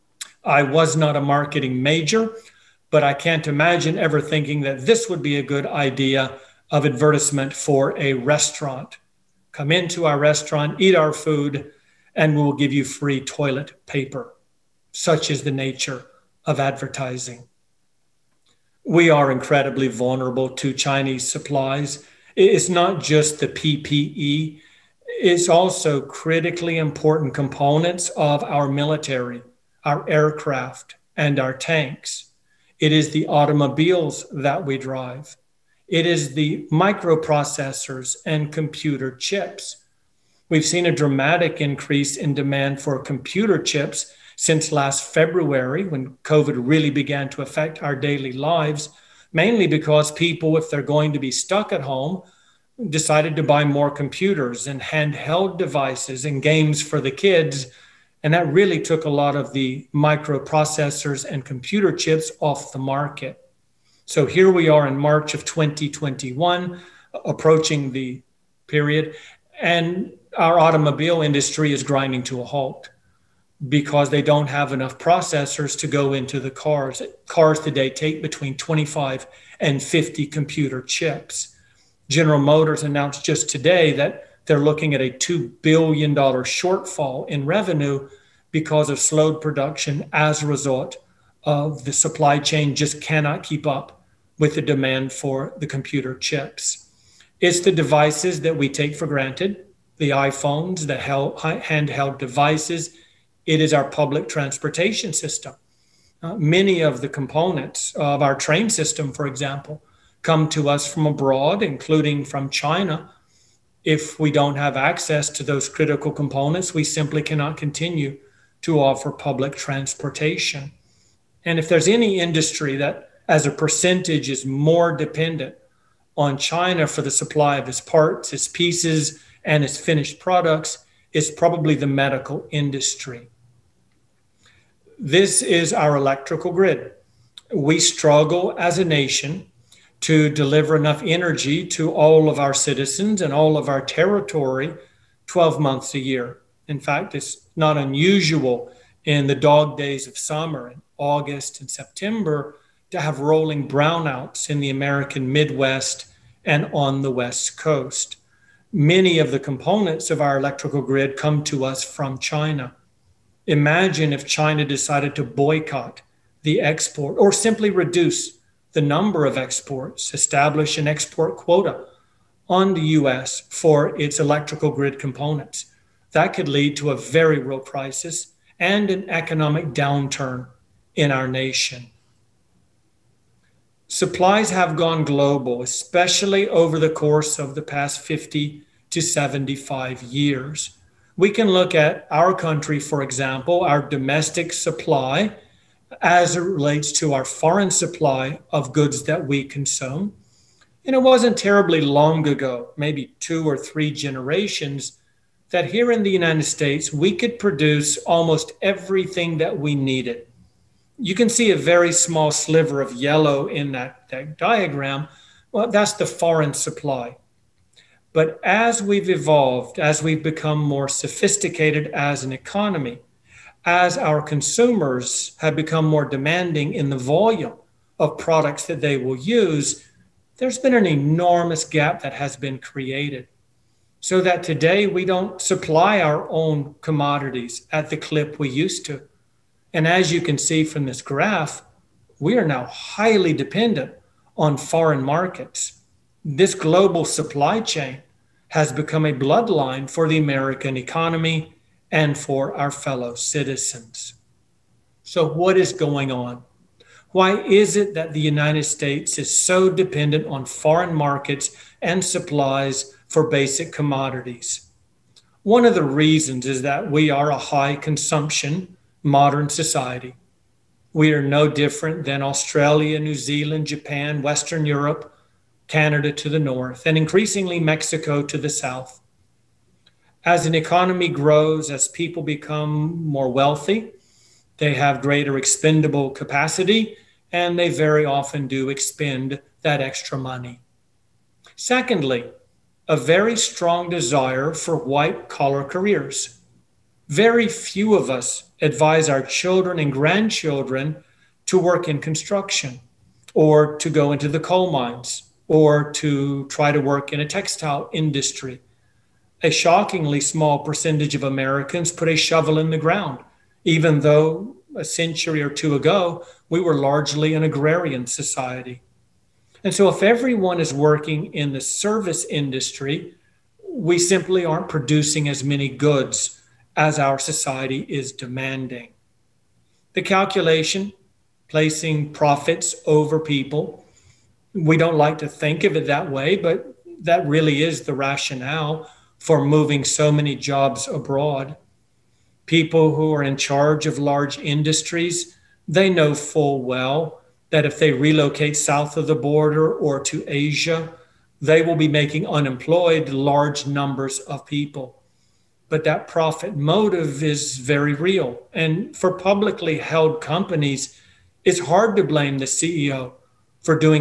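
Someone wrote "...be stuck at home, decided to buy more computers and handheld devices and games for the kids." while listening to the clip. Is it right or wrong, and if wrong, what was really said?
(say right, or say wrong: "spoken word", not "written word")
right.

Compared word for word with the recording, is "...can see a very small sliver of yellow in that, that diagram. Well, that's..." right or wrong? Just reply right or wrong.
right.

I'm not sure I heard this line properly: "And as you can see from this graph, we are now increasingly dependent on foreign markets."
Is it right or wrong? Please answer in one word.
wrong.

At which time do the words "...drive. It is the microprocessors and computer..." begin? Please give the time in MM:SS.
00:34.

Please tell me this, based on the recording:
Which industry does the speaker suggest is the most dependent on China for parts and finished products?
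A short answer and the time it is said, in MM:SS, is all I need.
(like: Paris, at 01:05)
medical industry, at 02:11.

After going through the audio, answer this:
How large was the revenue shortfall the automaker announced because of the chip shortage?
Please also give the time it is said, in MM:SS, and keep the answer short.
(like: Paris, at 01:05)
$2 billion, at 01:25.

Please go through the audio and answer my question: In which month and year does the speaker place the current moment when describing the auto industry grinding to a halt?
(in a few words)
March 2021.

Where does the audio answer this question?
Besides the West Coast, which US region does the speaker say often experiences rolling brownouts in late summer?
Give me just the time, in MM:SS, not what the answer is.
02:34.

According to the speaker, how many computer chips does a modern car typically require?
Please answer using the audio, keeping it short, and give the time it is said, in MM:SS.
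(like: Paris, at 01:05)
25 to 50, at 01:18.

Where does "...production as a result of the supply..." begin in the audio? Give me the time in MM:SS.
01:29.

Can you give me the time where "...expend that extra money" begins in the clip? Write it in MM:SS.
04:48.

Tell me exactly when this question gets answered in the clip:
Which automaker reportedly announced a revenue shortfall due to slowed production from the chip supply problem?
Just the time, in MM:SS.
01:22.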